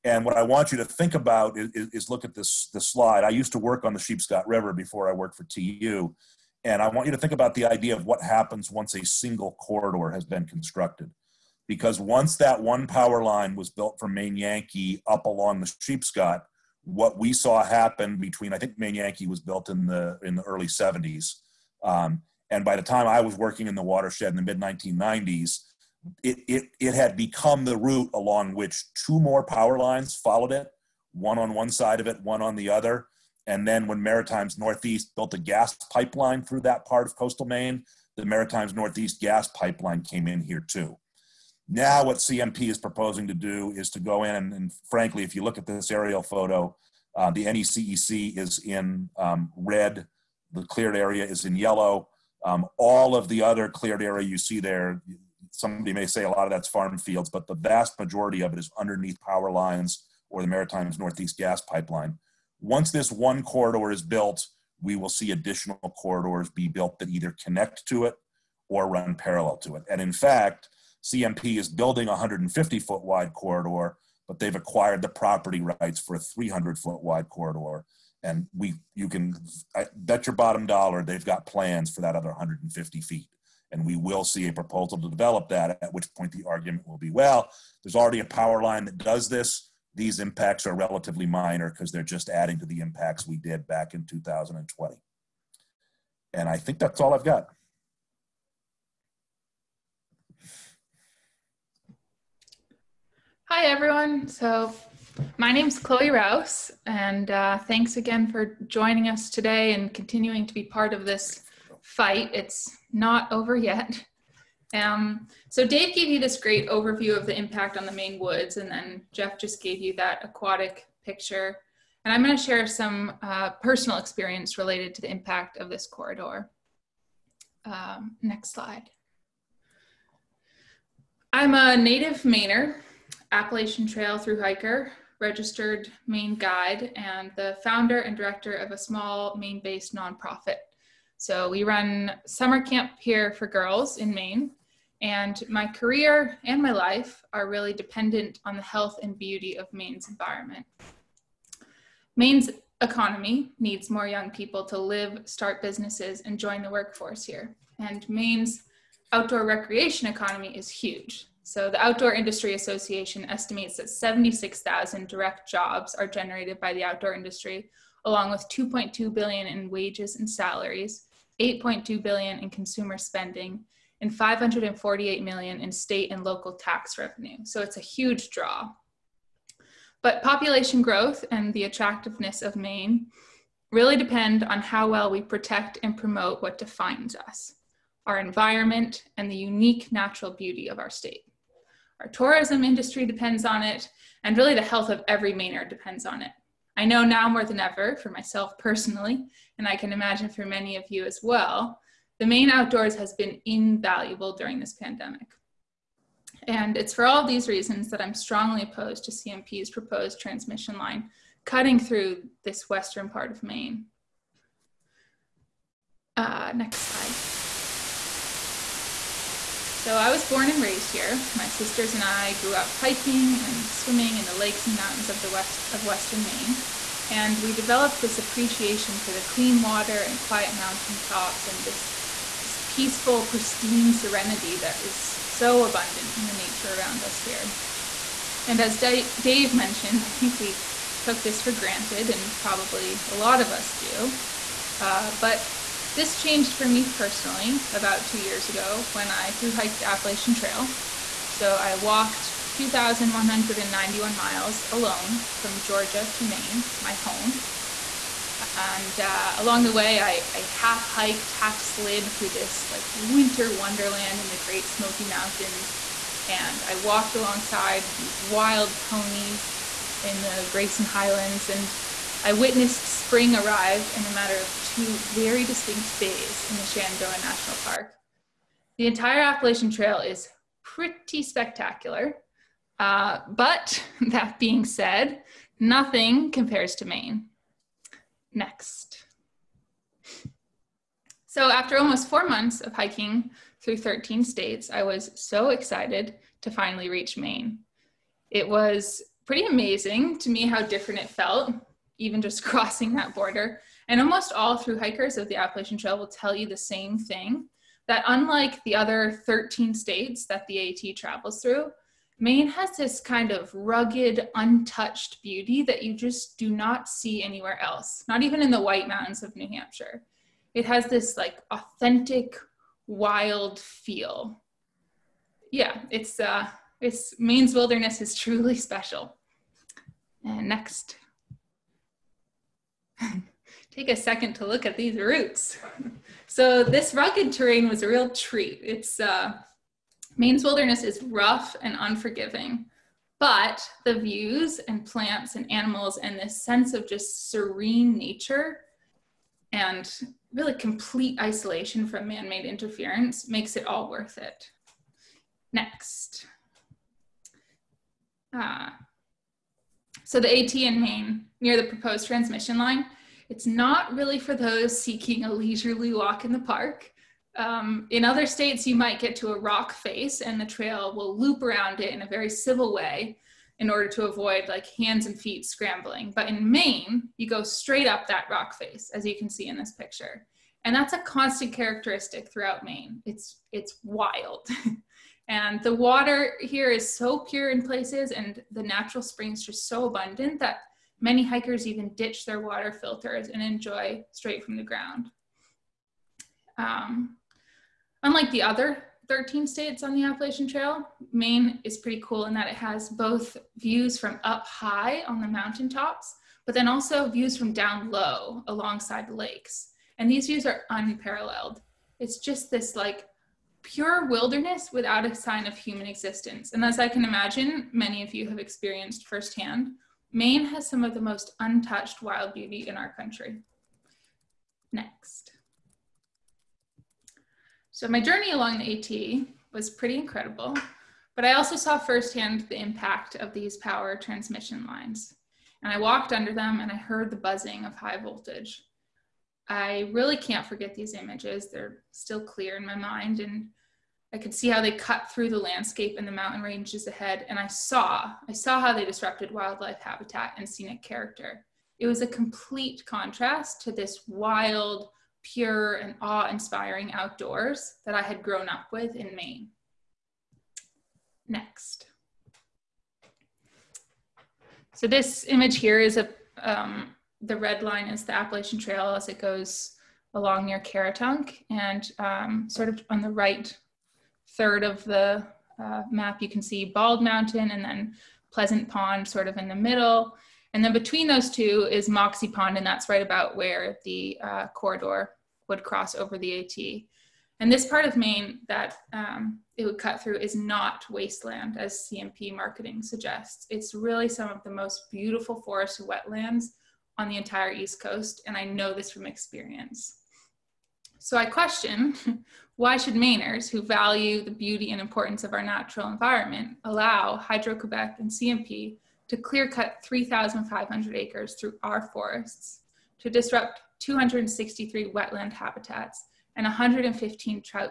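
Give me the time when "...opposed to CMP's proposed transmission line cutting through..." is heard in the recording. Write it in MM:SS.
03:28.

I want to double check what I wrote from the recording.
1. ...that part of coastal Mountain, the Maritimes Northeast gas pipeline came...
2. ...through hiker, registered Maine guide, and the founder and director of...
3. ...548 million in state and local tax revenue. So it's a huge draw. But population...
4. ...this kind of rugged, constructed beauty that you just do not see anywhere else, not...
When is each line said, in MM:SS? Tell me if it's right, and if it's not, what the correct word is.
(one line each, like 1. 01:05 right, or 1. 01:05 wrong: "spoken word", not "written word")
1. 00:36 wrong: "Maine", not "Mountain"
2. 02:14 right
3. 02:54 right
4. 05:12 wrong: "untouched", not "constructed".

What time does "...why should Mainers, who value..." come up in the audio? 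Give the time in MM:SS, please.
08:22.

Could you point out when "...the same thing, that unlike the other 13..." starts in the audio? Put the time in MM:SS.
05:06.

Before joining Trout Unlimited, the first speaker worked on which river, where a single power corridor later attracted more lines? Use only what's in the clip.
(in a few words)
Sheepscot River.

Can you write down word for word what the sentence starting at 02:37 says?
And Maine's outdoor recreation economy is huge.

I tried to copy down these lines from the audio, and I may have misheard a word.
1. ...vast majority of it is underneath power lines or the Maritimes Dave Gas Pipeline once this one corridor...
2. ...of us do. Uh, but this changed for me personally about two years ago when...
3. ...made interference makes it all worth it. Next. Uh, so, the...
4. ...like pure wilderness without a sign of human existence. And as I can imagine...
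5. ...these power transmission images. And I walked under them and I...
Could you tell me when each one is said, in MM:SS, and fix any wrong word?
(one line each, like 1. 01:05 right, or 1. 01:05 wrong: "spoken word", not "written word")
1. 00:57 wrong: "Northeast", not "Dave"
2. 04:03 right
3. 05:52 right
4. 06:52 right
5. 07:13 wrong: "lines", not "images".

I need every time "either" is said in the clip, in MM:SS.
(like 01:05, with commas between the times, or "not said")
01:07.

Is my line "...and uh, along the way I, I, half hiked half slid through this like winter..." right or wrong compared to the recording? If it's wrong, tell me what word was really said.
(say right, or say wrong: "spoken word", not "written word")
right.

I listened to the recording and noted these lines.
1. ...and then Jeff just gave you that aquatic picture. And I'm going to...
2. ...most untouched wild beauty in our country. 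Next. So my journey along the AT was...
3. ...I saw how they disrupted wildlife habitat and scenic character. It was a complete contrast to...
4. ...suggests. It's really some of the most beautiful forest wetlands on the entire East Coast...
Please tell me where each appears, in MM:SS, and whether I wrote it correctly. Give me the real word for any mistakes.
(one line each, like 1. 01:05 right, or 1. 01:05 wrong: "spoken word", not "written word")
1. 01:58 right
2. 07:01 right
3. 07:28 right
4. 08:12 right.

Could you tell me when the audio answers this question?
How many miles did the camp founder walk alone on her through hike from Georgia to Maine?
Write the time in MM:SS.
04:12.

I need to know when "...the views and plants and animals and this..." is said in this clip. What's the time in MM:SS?
05:43.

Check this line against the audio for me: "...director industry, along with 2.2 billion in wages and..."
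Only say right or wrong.
wrong.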